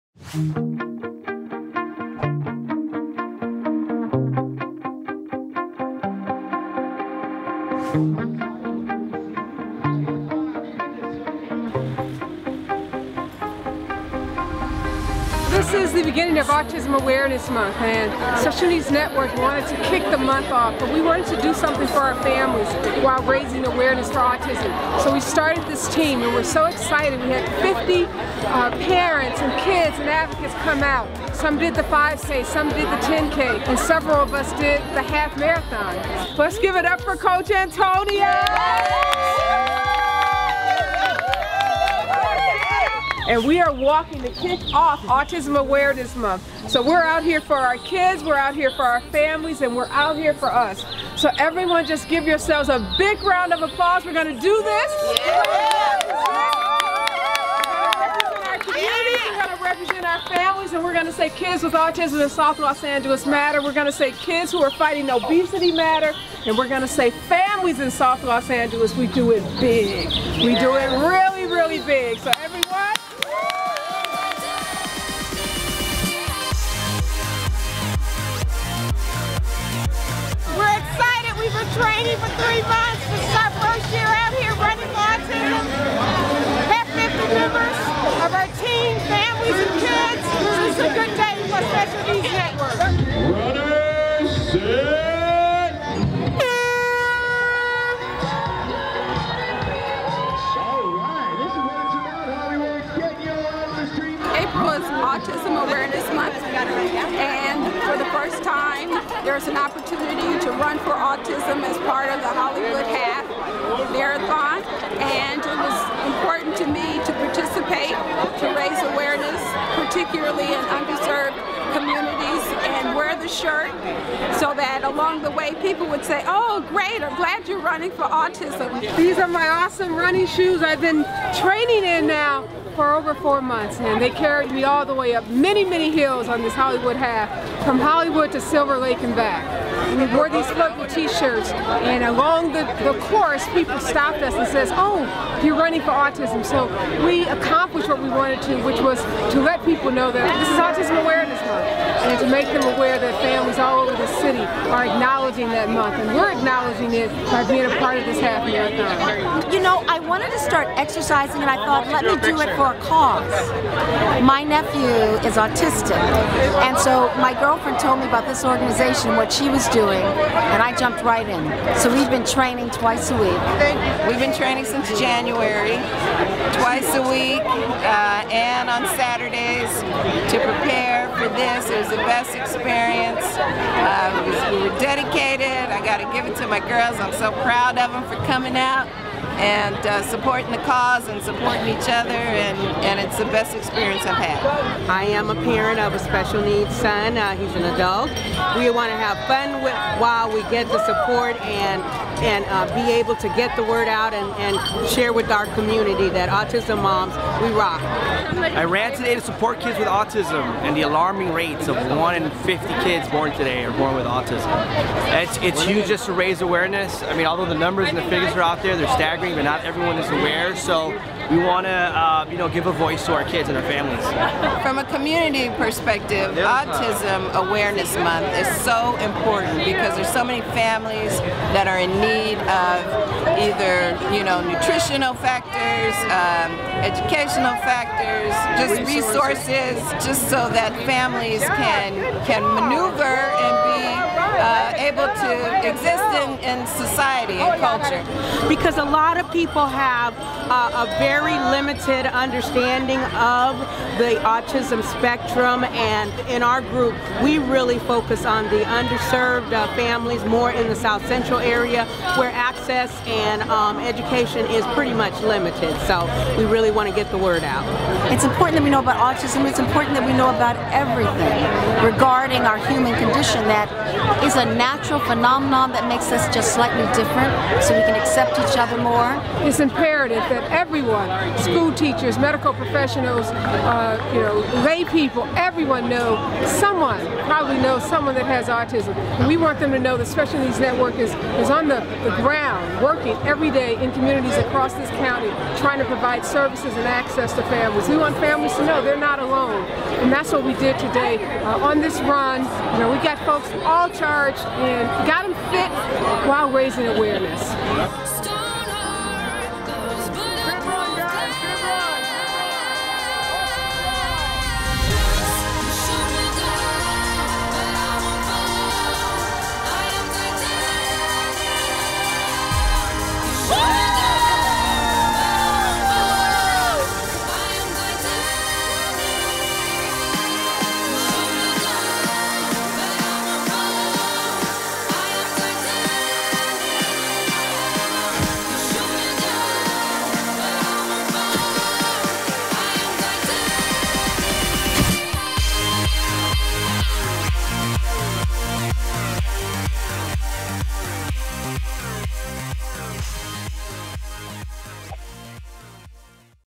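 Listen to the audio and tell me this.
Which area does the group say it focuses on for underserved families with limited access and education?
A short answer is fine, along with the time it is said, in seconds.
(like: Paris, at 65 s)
South Central, at 260 s.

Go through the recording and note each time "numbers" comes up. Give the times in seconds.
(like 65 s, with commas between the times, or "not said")
217 s.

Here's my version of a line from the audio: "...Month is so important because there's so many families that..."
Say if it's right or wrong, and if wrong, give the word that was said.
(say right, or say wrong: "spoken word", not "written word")
right.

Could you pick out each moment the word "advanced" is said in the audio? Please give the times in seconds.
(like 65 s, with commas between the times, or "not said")
not said.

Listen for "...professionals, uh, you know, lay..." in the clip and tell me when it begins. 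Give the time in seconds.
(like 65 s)
282 s.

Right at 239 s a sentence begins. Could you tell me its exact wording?
resources, just so that families can can maneuver and be uh, able to exist in, in society and culture.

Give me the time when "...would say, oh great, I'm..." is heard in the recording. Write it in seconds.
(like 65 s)
125 s.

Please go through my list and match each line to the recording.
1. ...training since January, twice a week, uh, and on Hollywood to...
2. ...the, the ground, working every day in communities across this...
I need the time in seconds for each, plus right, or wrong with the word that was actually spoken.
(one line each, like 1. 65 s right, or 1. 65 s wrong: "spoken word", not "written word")
1. 174 s wrong: "Saturdays", not "Hollywood"
2. 291 s right.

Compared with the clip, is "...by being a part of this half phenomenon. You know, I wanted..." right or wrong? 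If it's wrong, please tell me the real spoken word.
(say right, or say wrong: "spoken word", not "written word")
wrong: "marathon", not "phenomenon".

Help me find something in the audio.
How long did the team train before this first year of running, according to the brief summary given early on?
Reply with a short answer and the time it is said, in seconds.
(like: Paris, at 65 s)
3 months, at 82 s.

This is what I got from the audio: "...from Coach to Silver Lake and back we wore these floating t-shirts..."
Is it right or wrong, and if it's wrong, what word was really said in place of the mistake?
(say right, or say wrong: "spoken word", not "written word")
wrong: "Hollywood", not "Coach".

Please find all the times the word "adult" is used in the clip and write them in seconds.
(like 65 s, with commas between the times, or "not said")
197 s.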